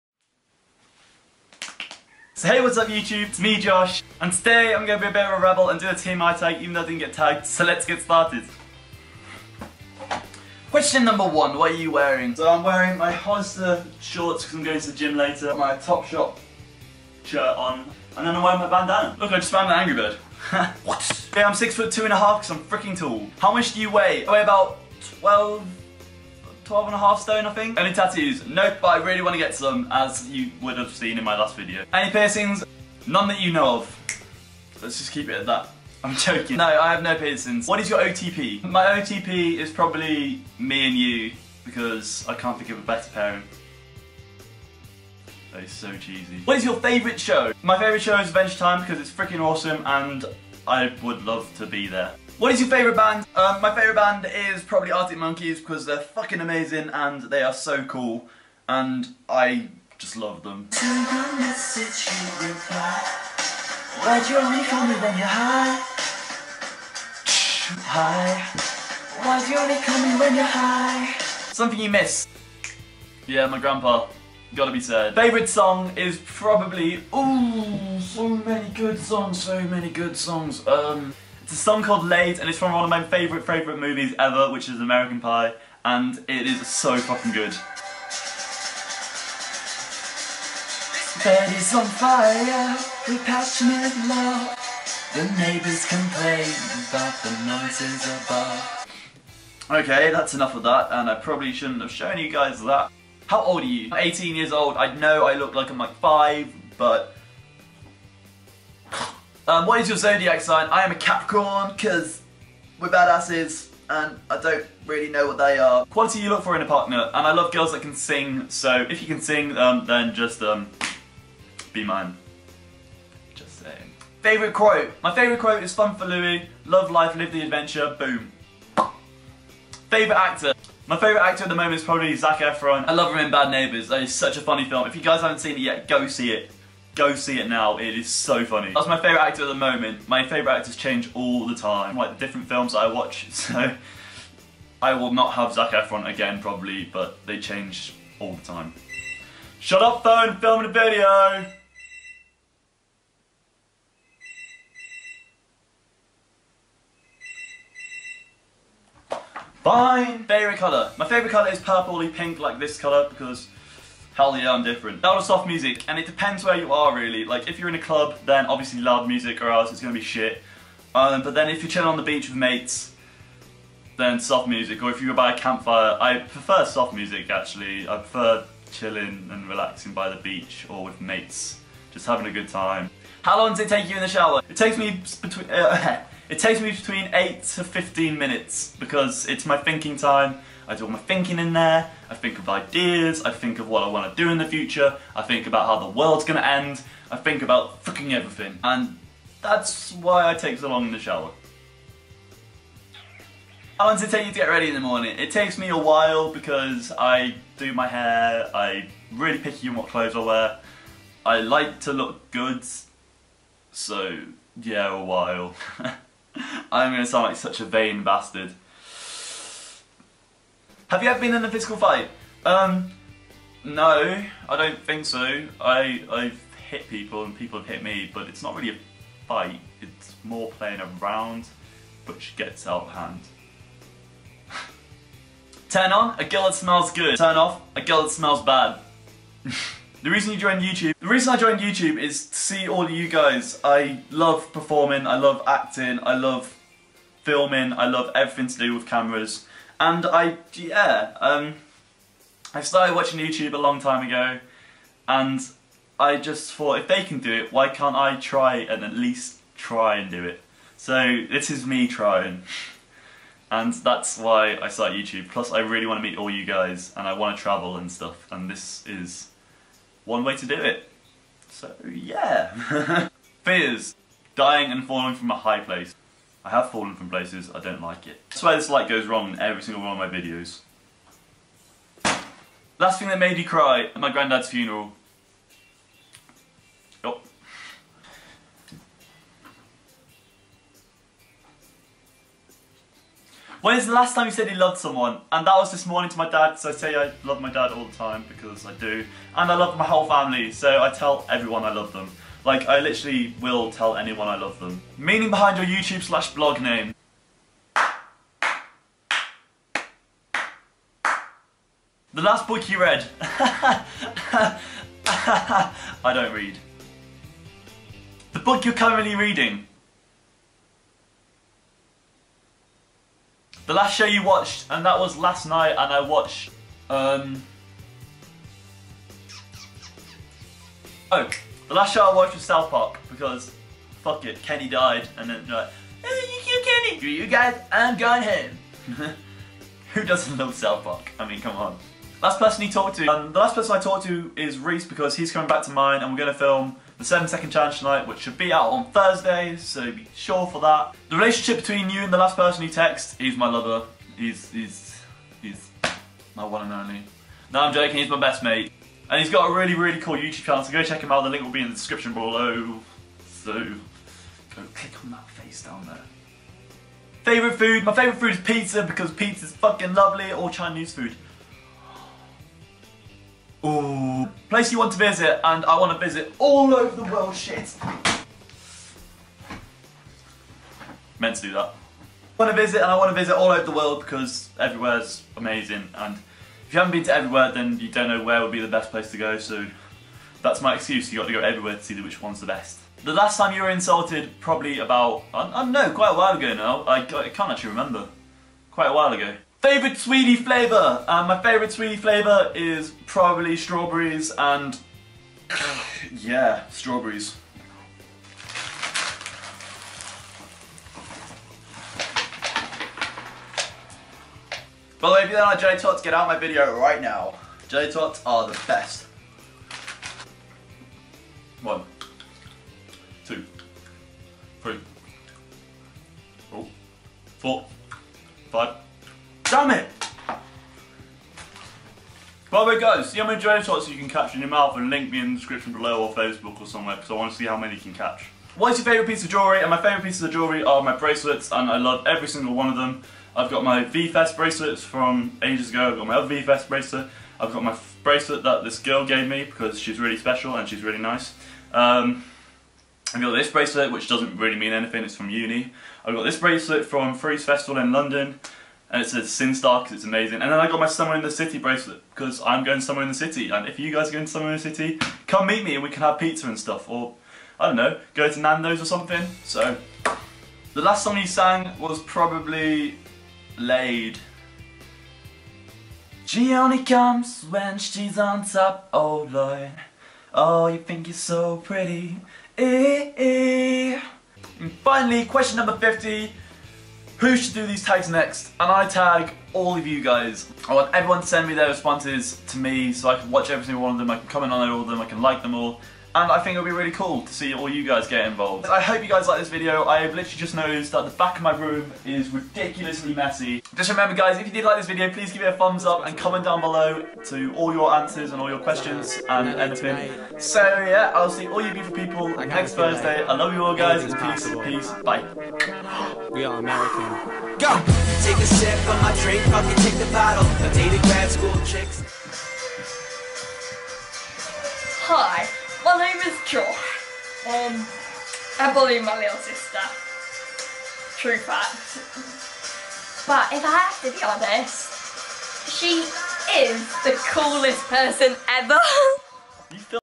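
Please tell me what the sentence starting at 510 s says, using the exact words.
So yeah, I'll see all you beautiful people next Thursday.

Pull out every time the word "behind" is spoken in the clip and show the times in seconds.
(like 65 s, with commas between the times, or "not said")
305 s.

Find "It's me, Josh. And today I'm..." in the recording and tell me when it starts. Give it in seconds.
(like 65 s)
3 s.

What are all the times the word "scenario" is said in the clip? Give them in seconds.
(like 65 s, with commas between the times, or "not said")
not said.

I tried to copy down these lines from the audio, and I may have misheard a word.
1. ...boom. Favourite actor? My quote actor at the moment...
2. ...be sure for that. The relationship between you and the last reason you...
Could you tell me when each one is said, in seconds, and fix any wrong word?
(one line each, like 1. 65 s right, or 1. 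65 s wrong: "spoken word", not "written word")
1. 127 s wrong: "favourite", not "quote"
2. 349 s wrong: "person", not "reason".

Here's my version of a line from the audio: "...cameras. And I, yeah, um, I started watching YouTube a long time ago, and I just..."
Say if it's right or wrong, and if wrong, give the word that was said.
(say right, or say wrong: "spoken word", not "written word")
right.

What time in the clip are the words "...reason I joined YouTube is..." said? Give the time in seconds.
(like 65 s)
241 s.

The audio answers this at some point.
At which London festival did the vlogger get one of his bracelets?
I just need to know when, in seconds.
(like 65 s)
457 s.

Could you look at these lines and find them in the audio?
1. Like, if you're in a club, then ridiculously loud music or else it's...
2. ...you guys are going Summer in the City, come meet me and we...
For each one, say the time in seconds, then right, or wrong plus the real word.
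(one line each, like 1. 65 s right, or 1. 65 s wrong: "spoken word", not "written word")
1. 167 s wrong: "obviously", not "ridiculously"
2. 463 s right.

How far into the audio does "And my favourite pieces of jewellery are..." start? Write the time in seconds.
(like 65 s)
439 s.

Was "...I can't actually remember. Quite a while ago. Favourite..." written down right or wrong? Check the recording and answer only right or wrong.
right.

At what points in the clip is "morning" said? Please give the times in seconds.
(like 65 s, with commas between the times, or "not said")
204 s, 295 s.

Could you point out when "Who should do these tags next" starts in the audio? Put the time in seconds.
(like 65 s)
487 s.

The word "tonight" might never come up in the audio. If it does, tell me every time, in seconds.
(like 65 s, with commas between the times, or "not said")
347 s.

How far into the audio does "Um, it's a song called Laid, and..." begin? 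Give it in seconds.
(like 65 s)
80 s.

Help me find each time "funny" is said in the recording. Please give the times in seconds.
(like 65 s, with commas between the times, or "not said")
134 s, 138 s.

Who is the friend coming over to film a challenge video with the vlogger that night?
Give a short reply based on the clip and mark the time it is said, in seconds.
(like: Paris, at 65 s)
Reese, at 344 s.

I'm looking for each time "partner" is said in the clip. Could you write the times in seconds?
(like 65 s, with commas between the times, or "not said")
116 s.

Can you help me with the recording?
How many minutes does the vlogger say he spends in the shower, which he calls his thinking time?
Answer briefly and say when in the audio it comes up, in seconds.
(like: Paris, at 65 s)
8 to 15 minutes, at 187 s.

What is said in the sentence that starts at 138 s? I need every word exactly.
That's my favourite actor at the moment.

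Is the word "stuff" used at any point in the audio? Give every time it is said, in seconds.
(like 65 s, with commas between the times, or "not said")
267 s, 466 s.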